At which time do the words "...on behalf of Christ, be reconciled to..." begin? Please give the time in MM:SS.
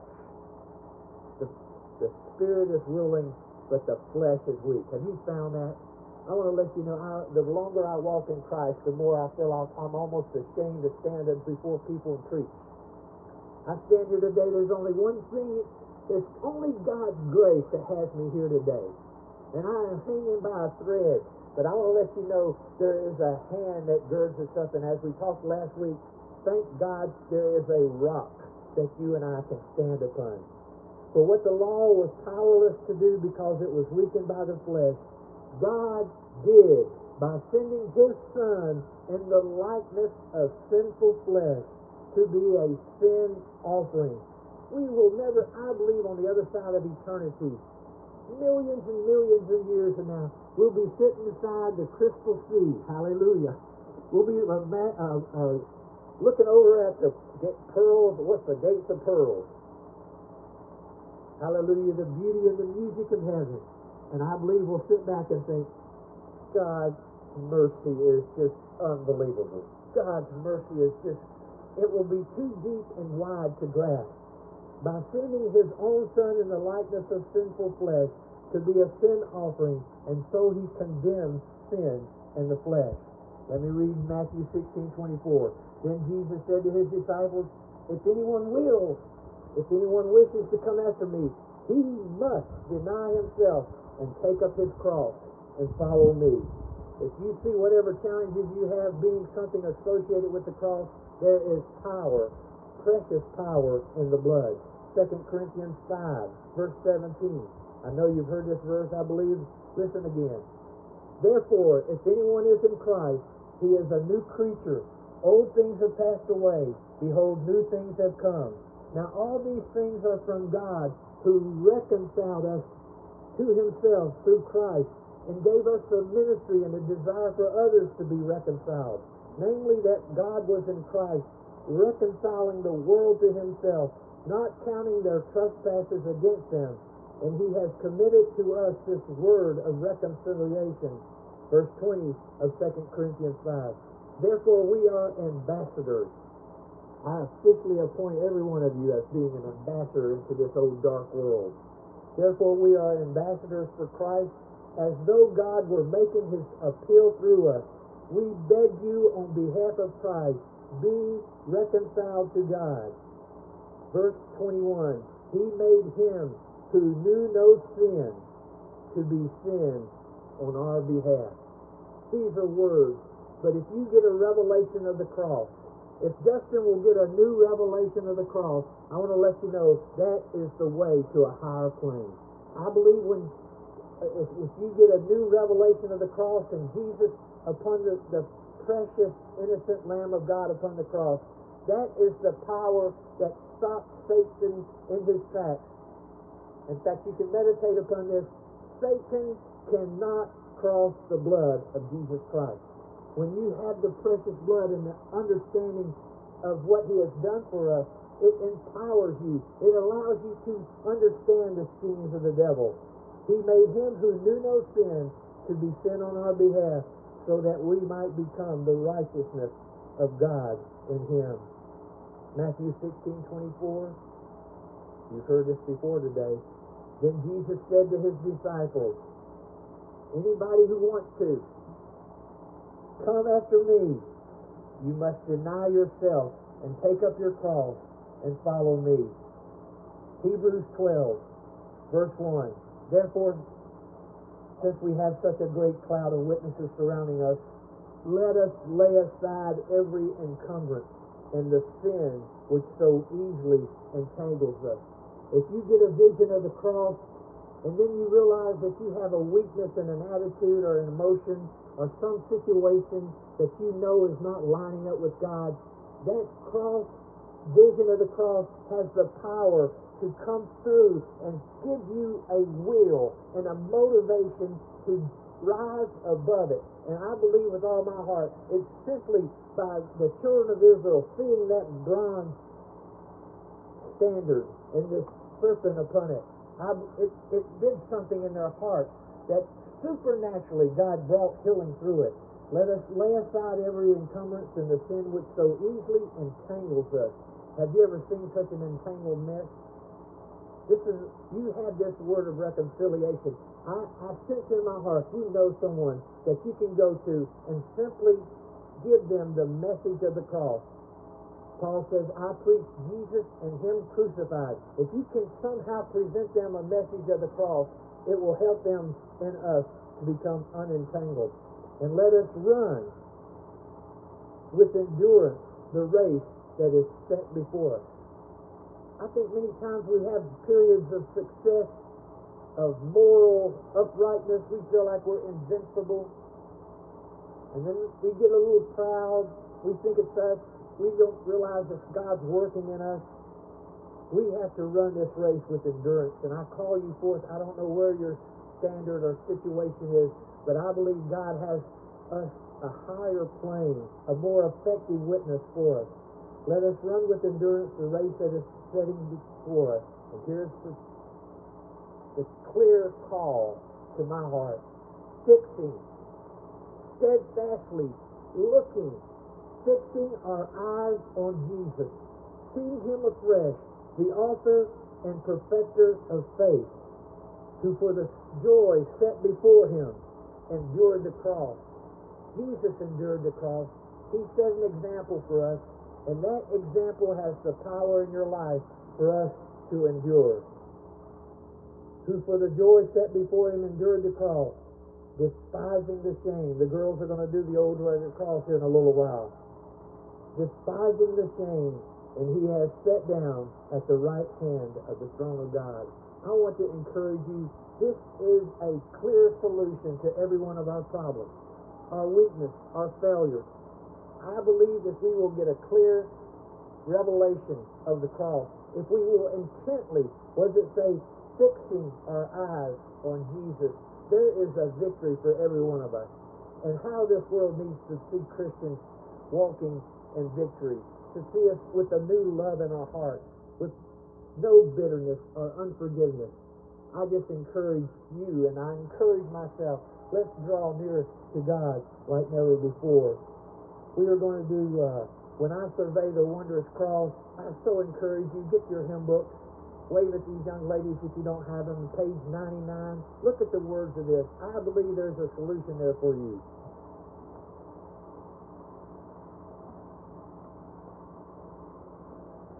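02:39.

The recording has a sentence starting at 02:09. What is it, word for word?
Namely, that God was in Christ, reconciling the world to himself, not counting their trespasses against them.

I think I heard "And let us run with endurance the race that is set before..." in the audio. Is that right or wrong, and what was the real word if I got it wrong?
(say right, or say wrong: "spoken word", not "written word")
right.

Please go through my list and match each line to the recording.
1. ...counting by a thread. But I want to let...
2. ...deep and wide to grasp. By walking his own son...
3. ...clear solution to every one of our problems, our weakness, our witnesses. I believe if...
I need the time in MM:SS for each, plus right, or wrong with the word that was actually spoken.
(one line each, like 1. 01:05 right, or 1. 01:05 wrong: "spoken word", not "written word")
1. 00:20 wrong: "hanging", not "counting"
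2. 01:12 wrong: "sending", not "walking"
3. 06:48 wrong: "failures", not "witnesses".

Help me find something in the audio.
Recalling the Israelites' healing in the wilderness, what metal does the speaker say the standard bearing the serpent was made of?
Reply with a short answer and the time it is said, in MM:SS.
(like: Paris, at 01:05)
bronze, at 04:41.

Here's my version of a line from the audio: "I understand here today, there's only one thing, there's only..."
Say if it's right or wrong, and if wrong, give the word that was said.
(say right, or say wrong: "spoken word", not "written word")
wrong: "stand", not "understand".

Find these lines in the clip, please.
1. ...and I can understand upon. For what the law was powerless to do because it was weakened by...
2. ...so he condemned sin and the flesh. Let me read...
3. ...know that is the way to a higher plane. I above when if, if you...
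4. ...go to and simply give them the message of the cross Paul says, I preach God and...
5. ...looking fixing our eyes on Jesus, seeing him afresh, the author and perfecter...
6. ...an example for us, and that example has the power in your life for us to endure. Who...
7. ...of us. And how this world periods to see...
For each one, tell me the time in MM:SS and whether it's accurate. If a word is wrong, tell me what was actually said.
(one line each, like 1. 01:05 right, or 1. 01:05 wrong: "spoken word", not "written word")
1. 00:29 wrong: "stand", not "understand"
2. 01:20 right
3. 02:59 wrong: "believe", not "above"
4. 05:06 wrong: "Jesus", not "God"
5. 06:08 right
6. 06:24 right
7. 07:05 wrong: "needs", not "periods".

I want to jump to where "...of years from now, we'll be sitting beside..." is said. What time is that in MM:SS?
00:49.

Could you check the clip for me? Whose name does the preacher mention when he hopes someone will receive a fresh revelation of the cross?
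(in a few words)
Justin.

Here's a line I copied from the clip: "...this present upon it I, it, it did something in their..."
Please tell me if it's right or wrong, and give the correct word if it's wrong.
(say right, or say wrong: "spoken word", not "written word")
wrong: "serpent", not "present".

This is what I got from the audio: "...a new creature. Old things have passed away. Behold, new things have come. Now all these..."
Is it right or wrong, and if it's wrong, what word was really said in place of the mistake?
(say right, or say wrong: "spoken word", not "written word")
right.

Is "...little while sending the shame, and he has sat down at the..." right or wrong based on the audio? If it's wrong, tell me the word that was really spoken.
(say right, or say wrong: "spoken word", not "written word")
wrong: "despising", not "sending".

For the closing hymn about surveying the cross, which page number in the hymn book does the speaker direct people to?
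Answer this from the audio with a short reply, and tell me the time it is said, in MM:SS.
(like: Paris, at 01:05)
99, at 07:31.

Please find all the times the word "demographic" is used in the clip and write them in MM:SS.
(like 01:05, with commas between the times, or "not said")
not said.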